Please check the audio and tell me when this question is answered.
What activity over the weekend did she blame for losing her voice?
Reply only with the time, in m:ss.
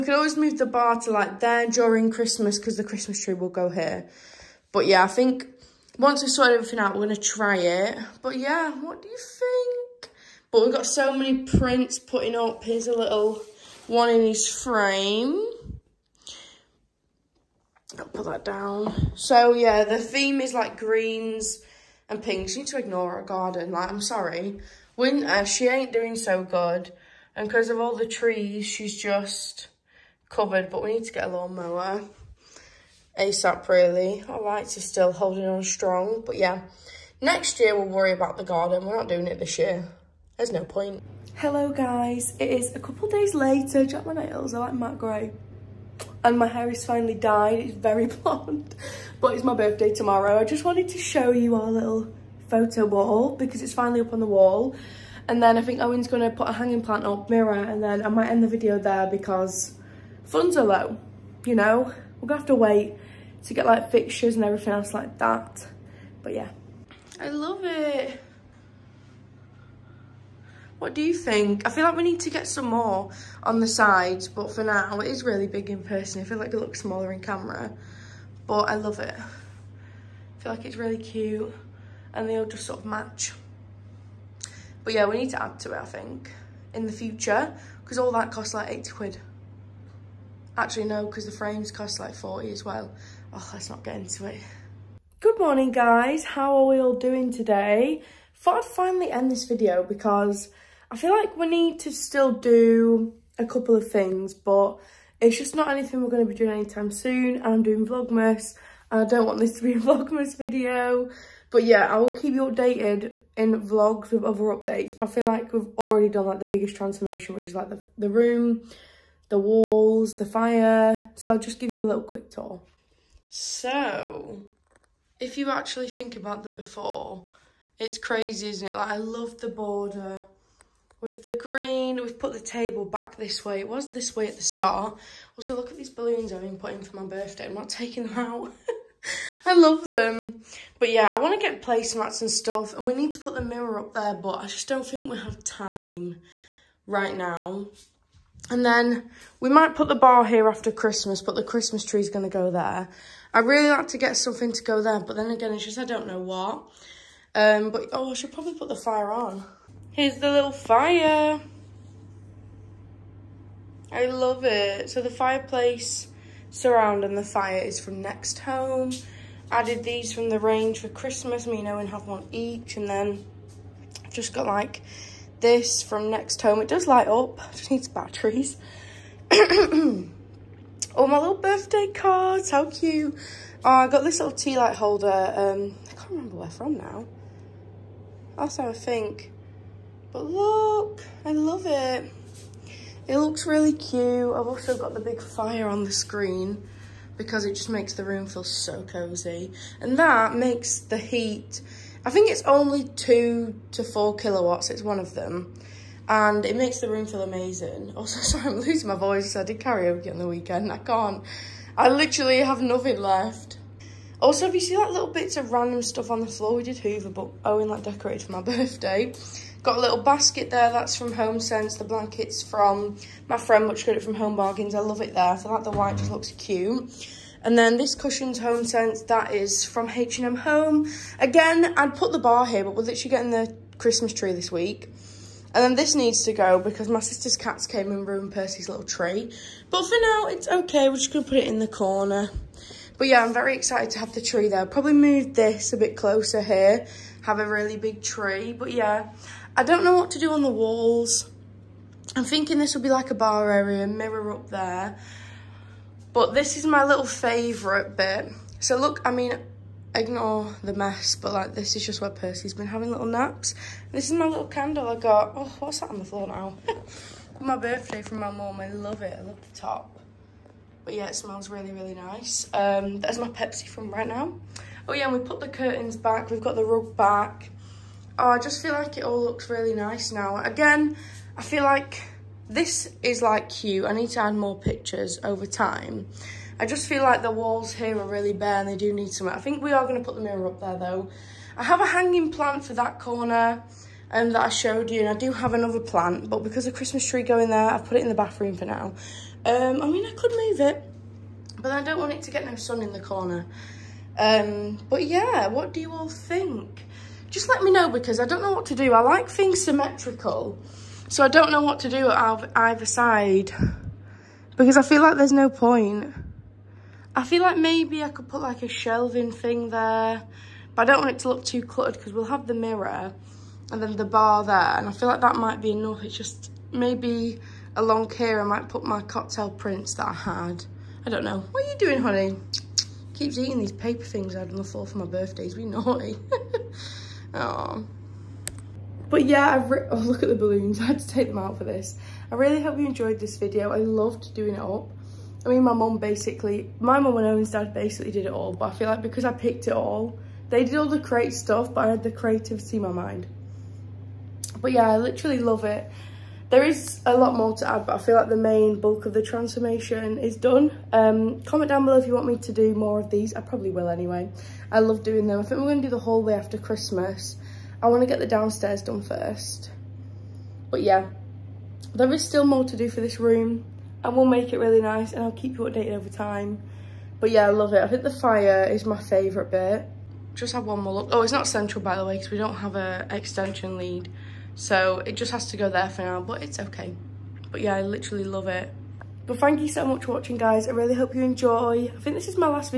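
3:29.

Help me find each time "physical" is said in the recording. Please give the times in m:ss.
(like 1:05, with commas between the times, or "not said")
not said.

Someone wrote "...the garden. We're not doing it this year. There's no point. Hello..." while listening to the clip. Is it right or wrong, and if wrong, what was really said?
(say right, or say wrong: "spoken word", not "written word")
right.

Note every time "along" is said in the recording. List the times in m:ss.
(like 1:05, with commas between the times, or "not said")
5:27.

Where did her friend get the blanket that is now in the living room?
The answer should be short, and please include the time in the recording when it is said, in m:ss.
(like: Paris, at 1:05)
Home Bargains, at 3:44.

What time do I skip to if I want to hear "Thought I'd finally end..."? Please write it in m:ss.
1:38.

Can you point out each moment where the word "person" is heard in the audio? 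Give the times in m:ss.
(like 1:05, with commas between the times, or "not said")
1:15.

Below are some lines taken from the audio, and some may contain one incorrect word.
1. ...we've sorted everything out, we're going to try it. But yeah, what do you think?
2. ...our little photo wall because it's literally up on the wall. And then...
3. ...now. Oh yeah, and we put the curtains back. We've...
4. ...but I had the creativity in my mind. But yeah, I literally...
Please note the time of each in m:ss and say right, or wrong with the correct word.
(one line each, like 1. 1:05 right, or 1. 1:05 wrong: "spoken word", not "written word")
1. 0:06 right
2. 0:51 wrong: "finally", not "literally"
3. 4:34 right
4. 5:51 right.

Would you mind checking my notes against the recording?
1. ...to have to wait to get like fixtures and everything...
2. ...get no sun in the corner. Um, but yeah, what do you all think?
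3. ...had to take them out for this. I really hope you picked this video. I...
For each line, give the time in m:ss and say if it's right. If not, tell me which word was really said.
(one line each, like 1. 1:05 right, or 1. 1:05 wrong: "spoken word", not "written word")
1. 1:02 right
2. 5:02 right
3. 5:40 wrong: "enjoyed", not "picked".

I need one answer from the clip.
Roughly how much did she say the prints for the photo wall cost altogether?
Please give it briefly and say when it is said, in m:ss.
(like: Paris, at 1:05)
80 quid, at 1:28.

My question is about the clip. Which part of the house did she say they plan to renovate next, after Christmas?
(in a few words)
The hallway.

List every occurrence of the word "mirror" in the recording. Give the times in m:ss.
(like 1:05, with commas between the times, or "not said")
0:57, 2:23, 4:13, 4:50, 5:22.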